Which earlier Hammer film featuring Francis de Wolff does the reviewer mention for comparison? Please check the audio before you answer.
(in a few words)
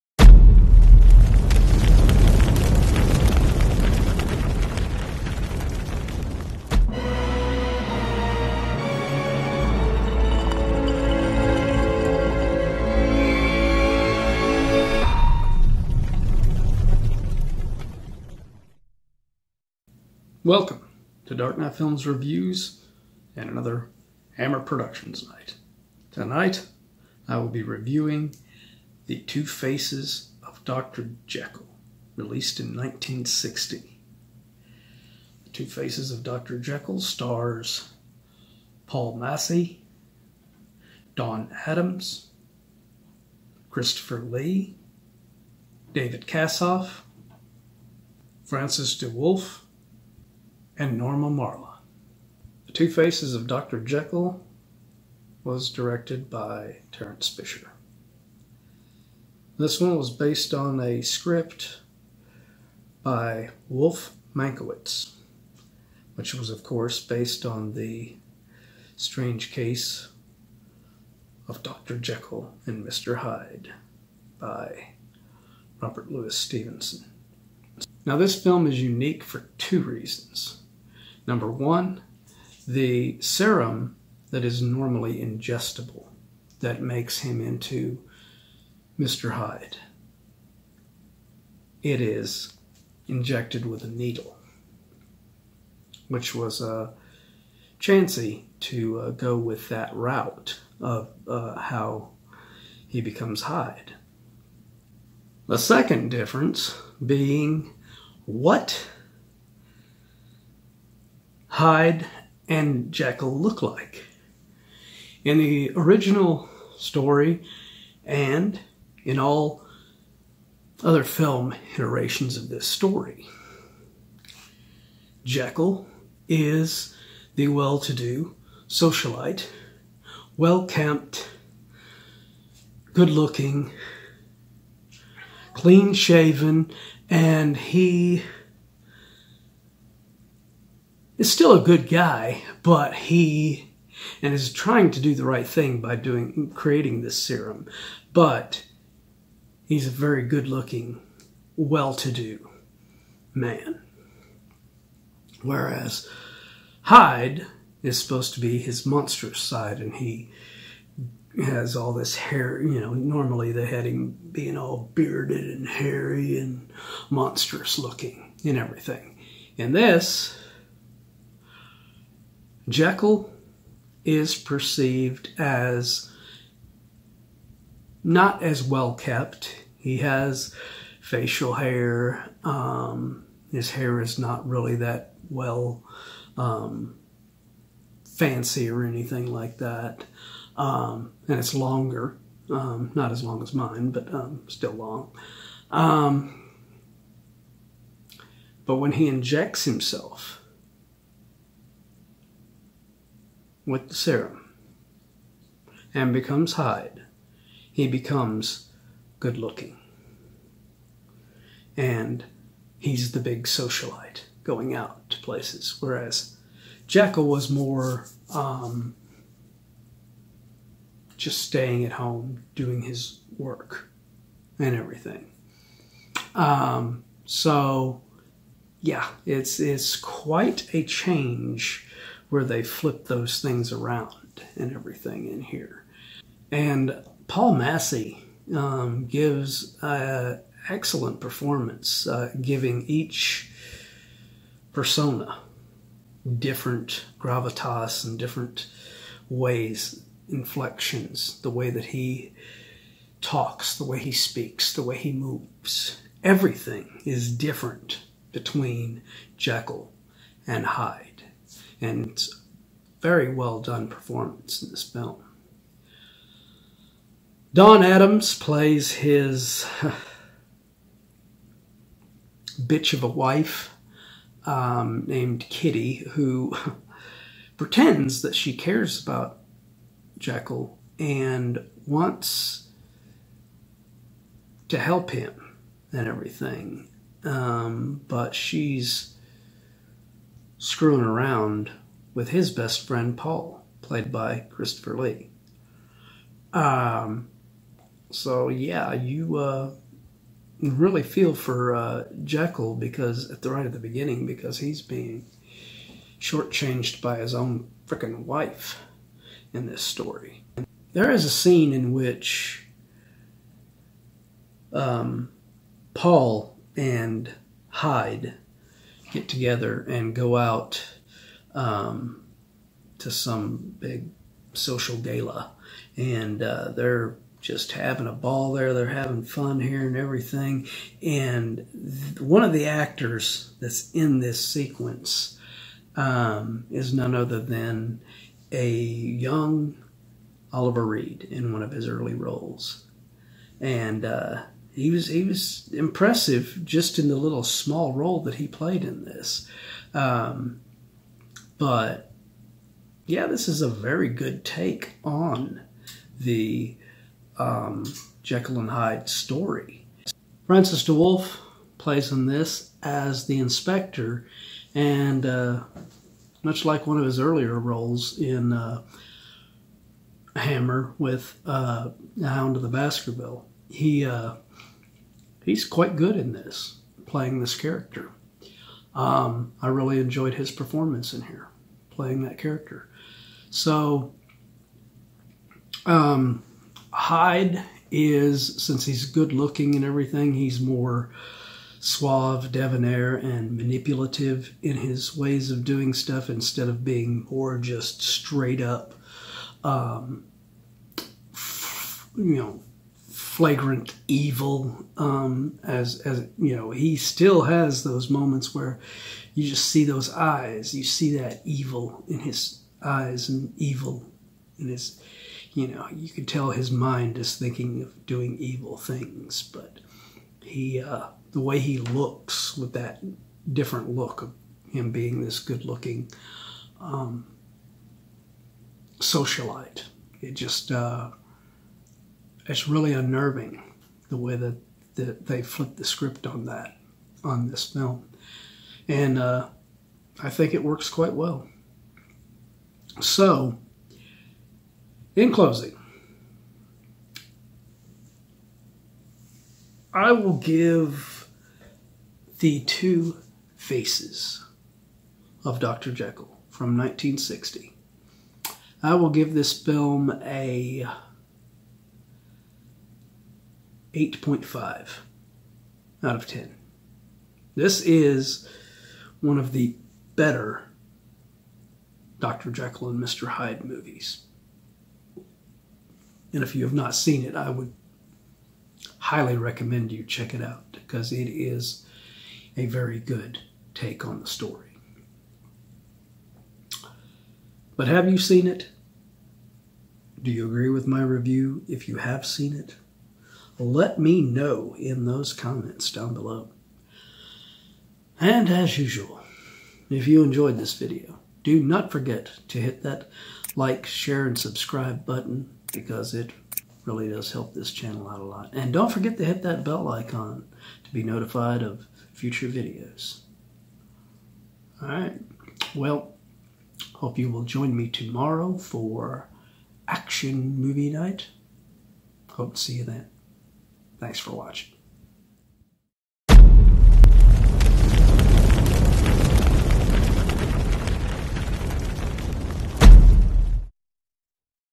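Hound of the Baskerville.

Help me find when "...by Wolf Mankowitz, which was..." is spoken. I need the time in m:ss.
1:03.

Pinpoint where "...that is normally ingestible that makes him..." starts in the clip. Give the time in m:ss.
1:24.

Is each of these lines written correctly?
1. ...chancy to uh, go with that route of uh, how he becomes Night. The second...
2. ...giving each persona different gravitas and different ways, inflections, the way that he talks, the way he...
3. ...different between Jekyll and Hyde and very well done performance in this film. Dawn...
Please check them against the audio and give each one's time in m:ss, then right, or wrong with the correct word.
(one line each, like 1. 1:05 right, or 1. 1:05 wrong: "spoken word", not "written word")
1. 1:37 wrong: "Hyde", not "Night"
2. 4:02 right
3. 4:17 right.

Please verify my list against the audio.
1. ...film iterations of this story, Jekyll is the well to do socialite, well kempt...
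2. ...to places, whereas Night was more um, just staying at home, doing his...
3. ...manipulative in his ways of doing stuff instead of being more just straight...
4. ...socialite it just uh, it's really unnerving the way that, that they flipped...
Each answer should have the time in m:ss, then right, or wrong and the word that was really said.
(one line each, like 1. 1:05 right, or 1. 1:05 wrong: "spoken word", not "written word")
1. 2:01 right
2. 3:35 wrong: "Jekyll", not "Night"
3. 6:33 right
4. 7:08 right.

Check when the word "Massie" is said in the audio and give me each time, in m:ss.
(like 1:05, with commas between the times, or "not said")
0:39, 3:57.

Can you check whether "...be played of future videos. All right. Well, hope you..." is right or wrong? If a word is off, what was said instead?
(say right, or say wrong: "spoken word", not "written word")
wrong: "notified", not "played".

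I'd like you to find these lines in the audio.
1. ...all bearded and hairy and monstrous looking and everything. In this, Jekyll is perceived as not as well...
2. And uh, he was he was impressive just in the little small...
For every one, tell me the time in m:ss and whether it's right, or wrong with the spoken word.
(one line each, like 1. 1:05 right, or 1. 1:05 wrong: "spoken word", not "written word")
1. 2:44 right
2. 5:43 right.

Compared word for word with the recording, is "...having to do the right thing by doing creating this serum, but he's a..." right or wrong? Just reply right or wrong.
wrong.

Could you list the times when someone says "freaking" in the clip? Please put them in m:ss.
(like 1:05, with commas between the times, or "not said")
5:07.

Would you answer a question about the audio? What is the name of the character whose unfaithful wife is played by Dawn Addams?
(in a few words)
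Kitty.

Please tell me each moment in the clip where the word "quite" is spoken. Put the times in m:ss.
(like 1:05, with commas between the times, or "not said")
3:49, 6:15, 7:20.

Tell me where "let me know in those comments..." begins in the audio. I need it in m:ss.
8:13.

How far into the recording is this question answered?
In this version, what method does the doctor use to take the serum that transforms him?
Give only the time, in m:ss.
1:33.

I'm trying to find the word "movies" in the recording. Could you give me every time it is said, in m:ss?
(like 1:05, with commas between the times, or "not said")
7:53, 8:40.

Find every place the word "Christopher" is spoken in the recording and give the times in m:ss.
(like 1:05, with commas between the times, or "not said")
0:43, 4:54.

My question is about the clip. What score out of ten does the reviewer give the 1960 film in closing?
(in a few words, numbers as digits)
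8.5.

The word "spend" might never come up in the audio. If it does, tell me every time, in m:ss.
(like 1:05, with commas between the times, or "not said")
not said.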